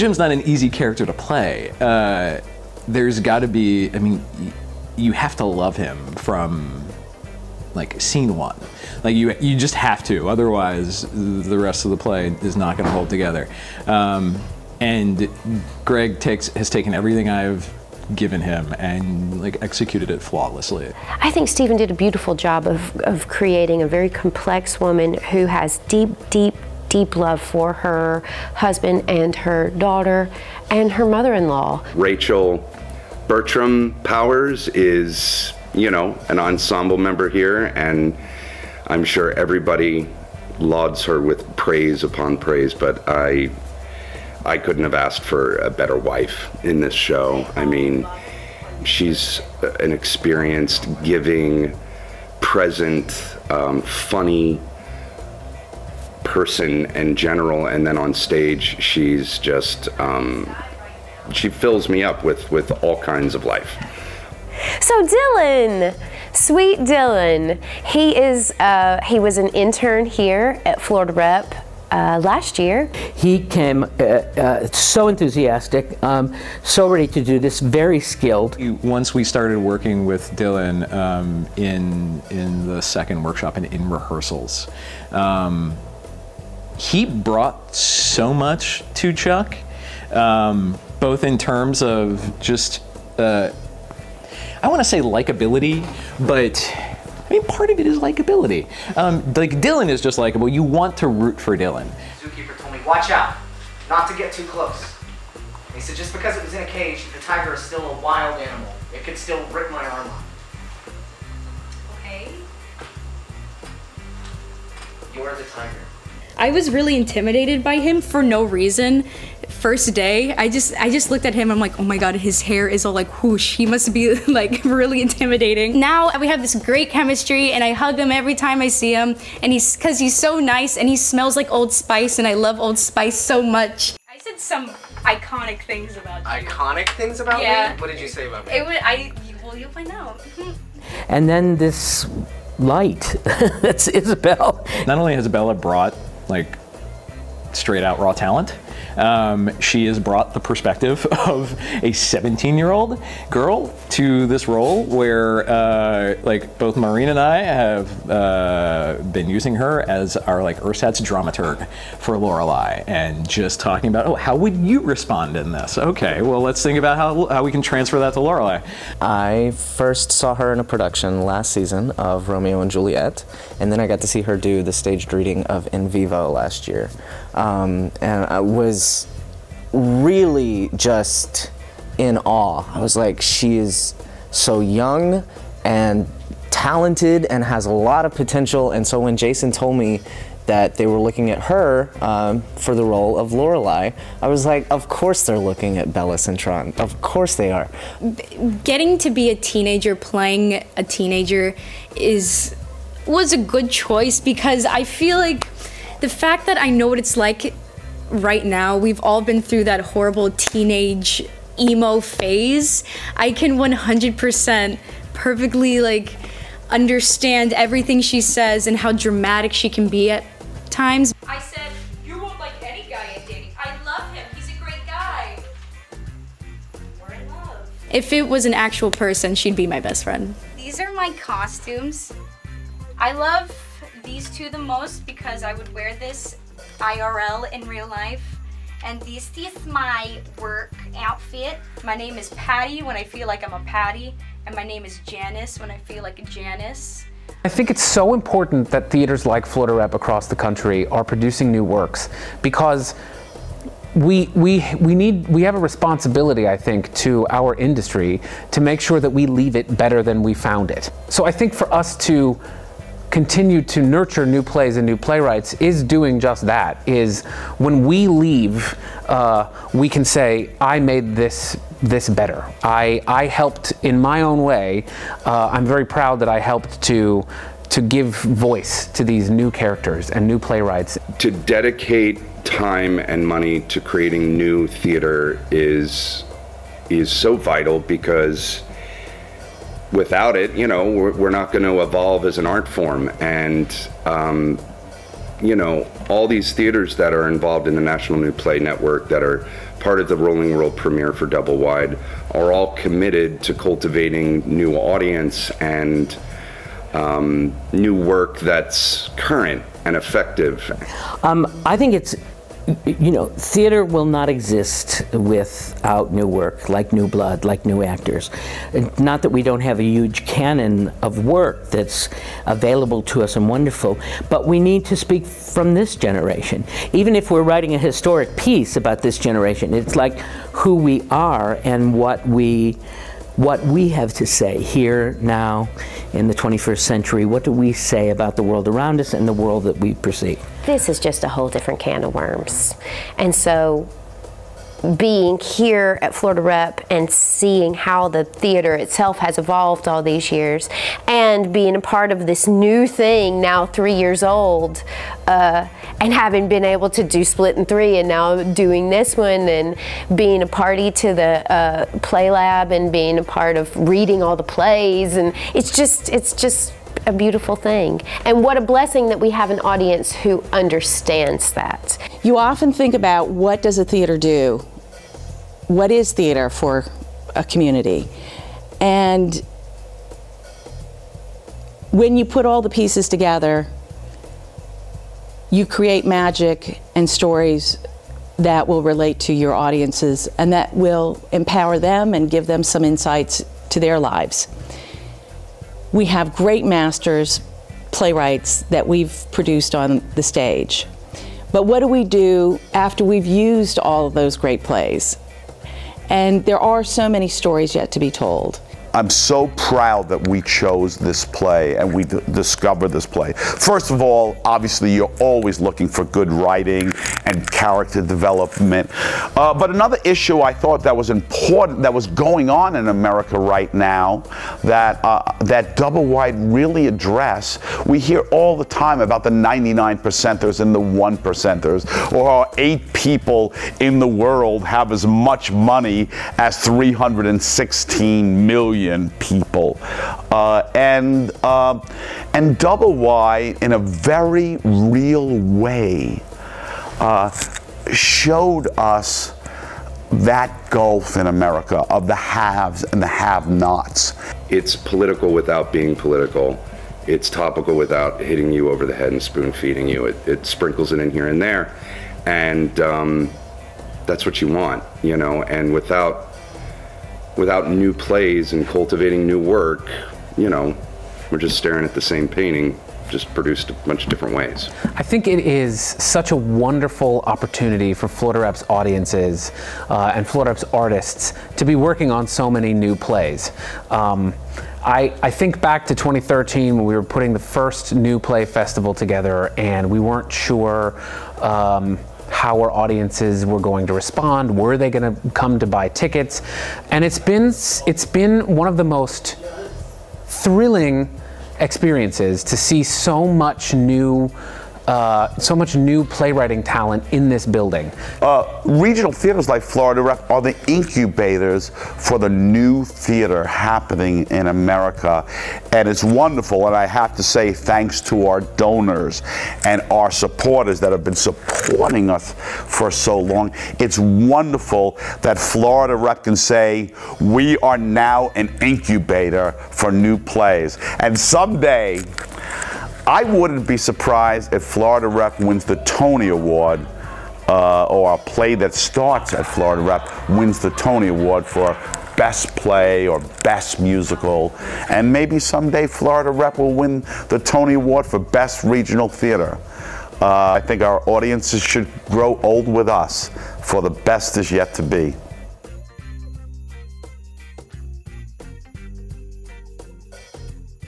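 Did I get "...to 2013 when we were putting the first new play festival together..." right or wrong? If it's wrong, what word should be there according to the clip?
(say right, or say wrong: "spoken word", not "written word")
right.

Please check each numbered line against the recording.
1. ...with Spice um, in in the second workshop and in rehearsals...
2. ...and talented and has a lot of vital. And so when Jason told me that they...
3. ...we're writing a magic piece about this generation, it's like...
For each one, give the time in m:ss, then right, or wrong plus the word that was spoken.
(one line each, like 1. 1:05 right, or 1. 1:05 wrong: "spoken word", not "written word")
1. 1:20 wrong: "Dillion", not "Spice"
2. 3:05 wrong: "potential", not "vital"
3. 5:27 wrong: "historic", not "magic".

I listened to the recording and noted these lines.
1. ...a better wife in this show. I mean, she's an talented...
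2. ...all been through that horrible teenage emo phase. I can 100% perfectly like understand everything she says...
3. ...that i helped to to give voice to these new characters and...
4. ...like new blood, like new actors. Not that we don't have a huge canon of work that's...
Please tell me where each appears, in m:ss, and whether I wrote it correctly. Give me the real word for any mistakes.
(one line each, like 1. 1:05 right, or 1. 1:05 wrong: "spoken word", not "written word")
1. 0:45 wrong: "experienced", not "talented"
2. 3:29 right
3. 4:36 right
4. 5:16 right.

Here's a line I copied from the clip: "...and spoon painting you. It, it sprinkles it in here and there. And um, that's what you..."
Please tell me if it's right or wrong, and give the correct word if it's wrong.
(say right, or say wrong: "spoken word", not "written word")
wrong: "feeding", not "painting".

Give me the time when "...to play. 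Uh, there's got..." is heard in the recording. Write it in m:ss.
0:01.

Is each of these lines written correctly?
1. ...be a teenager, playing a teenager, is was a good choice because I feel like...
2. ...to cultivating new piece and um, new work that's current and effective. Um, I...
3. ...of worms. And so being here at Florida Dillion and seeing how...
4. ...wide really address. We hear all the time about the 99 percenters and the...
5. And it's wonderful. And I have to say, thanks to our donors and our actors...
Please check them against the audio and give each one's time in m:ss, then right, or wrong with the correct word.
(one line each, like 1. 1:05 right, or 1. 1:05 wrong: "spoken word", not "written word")
1. 3:19 right
2. 5:03 wrong: "audience", not "piece"
3. 5:42 wrong: "Rep", not "Dillion"
4. 7:06 right
5. 8:35 wrong: "supporters", not "actors".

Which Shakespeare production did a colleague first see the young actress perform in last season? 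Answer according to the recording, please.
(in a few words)
Romeo and Juliet.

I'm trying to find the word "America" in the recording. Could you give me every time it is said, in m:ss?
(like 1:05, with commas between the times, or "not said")
7:02, 7:31, 8:34.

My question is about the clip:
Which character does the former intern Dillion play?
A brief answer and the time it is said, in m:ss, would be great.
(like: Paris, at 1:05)
Chuck, at 1:29.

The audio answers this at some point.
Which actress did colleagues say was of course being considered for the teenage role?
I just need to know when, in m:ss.
3:15.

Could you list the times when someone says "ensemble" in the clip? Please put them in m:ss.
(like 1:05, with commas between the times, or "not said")
0:36.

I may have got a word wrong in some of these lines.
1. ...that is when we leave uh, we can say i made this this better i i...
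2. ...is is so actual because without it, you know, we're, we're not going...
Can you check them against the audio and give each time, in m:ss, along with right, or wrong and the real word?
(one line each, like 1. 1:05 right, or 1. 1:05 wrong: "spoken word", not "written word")
1. 4:26 right
2. 4:45 wrong: "vital", not "actual".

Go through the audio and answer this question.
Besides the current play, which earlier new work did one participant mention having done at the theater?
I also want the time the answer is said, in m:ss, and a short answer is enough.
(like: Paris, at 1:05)
Split in Three, at 5:57.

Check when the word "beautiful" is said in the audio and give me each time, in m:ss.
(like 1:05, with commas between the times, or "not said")
0:21, 6:07.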